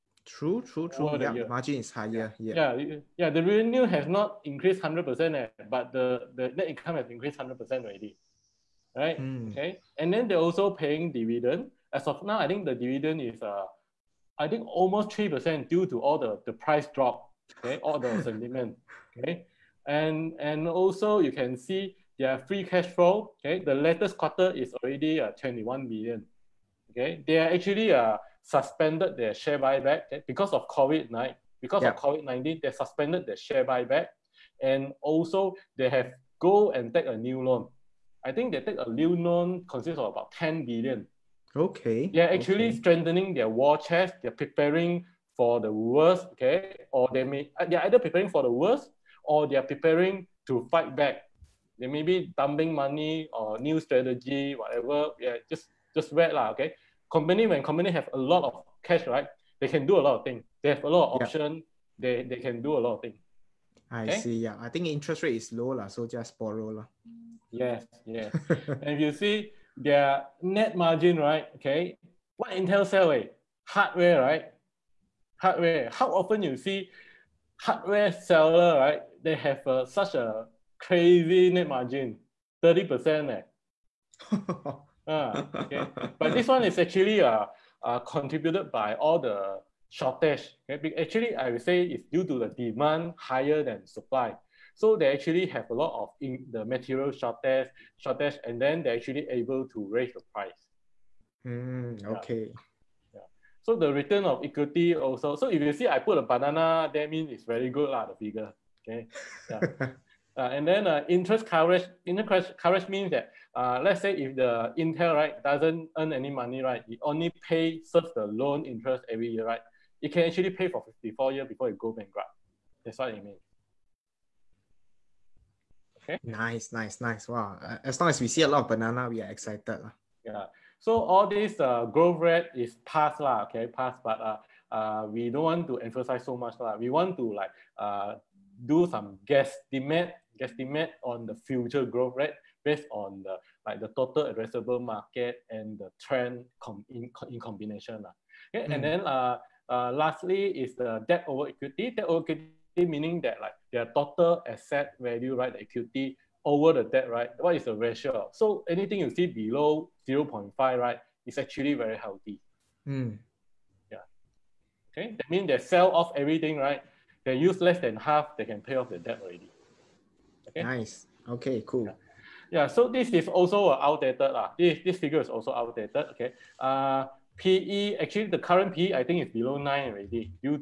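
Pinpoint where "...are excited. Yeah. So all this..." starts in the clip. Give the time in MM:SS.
02:09.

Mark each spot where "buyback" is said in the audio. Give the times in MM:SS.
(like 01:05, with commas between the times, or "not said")
00:29, 00:33.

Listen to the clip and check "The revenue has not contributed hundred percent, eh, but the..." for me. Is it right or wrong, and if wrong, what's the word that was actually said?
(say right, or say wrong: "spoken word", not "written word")
wrong: "increased", not "contributed".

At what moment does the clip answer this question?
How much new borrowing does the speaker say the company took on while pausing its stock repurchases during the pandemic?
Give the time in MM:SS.
00:40.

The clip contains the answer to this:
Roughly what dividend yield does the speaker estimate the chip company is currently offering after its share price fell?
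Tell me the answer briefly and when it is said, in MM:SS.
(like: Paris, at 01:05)
3 percent, at 00:15.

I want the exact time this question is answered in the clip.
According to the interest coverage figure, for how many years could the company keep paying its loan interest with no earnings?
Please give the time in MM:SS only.
02:00.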